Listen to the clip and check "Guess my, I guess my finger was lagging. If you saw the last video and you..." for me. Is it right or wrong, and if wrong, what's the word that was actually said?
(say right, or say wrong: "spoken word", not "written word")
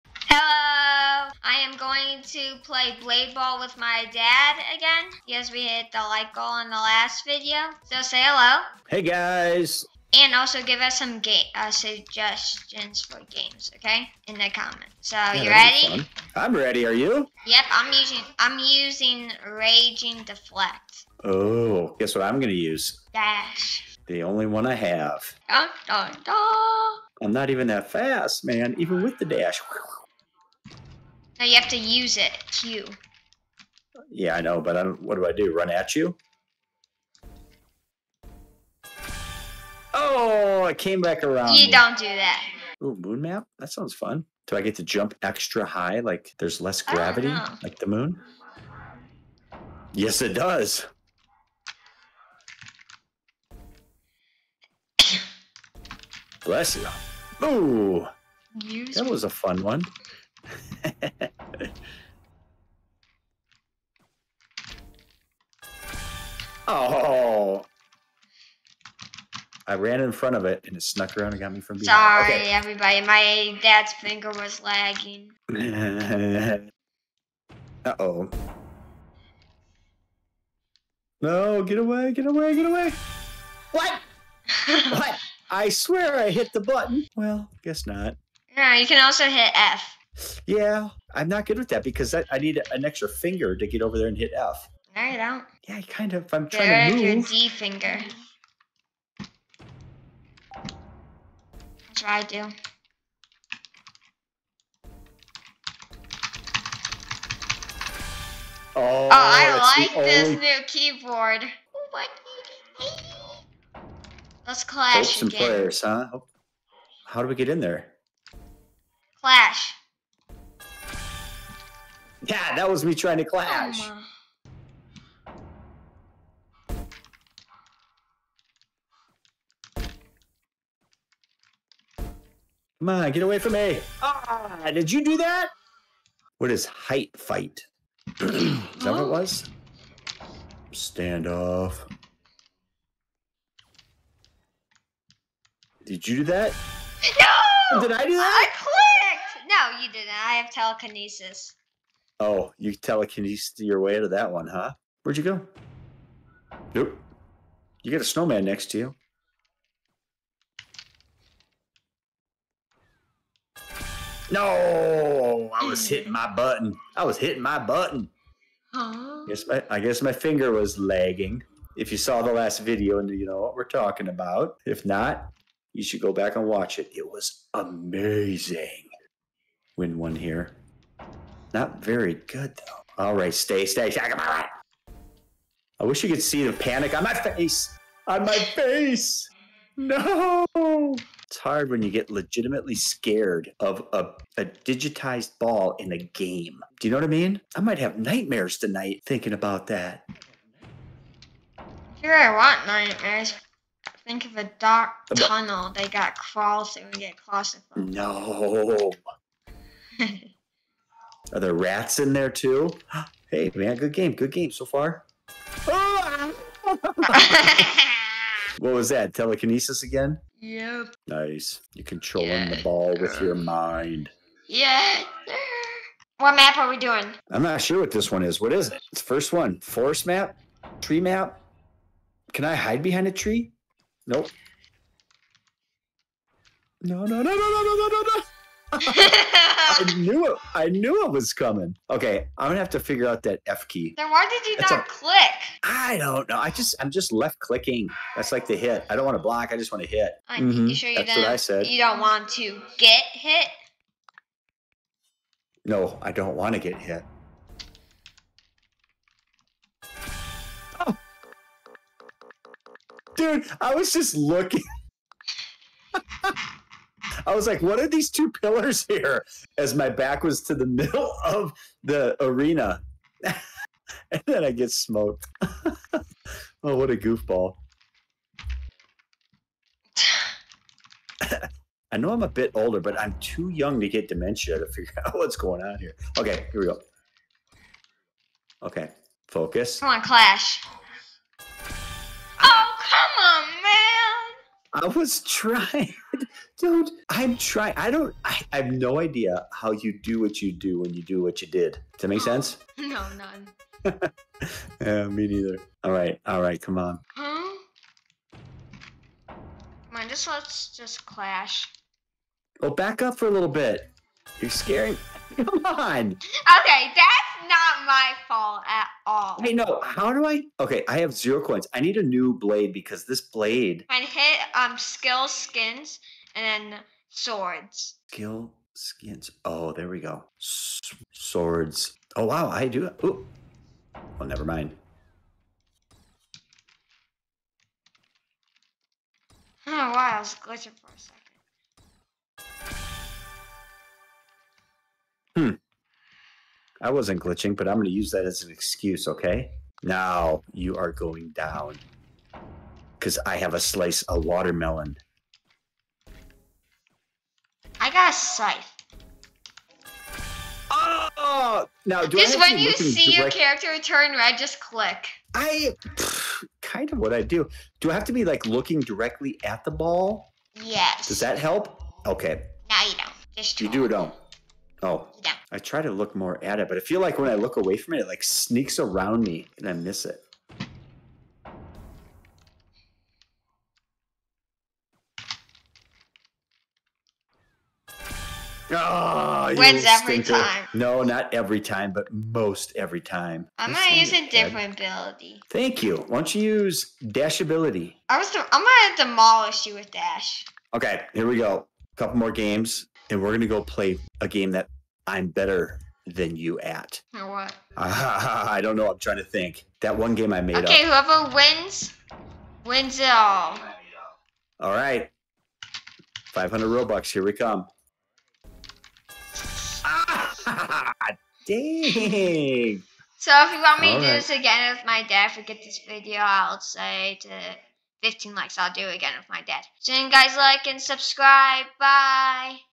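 right.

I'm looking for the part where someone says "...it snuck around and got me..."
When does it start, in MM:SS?
01:10.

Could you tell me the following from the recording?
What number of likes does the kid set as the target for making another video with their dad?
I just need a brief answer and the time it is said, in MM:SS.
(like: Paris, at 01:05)
15, at 07:08.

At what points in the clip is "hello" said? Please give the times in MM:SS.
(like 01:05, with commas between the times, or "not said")
00:08.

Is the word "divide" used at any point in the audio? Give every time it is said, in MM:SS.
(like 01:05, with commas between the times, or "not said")
not said.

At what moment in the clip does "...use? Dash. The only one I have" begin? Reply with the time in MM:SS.
00:22.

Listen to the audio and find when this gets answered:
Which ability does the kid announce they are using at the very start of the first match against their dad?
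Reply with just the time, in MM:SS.
00:19.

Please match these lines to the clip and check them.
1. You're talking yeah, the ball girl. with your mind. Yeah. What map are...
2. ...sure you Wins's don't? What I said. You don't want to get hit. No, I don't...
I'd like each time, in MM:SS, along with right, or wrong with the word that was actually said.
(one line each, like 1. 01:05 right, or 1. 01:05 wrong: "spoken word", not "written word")
1. 03:41 wrong: "controlling", not "talking"
2. 04:10 wrong: "That", not "Wins".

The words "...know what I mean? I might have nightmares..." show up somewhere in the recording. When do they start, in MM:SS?
03:16.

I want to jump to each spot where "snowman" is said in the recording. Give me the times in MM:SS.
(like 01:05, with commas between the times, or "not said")
02:38.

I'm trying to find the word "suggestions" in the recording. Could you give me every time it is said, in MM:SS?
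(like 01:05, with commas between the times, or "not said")
00:11.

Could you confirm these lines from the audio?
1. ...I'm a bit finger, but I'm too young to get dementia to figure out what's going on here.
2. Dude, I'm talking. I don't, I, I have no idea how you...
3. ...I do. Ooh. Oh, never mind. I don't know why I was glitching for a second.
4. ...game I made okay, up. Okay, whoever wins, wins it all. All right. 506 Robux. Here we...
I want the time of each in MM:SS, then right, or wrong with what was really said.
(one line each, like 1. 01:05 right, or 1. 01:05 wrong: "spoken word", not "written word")
1. 04:42 wrong: "older", not "finger"
2. 04:56 wrong: "trying", not "talking"
3. 05:32 right
4. 06:50 wrong: "500", not "506".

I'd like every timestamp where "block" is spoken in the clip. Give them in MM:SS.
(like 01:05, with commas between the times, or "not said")
04:09.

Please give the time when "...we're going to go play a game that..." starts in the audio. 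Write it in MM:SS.
06:43.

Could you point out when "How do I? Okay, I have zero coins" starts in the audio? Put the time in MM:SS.
05:19.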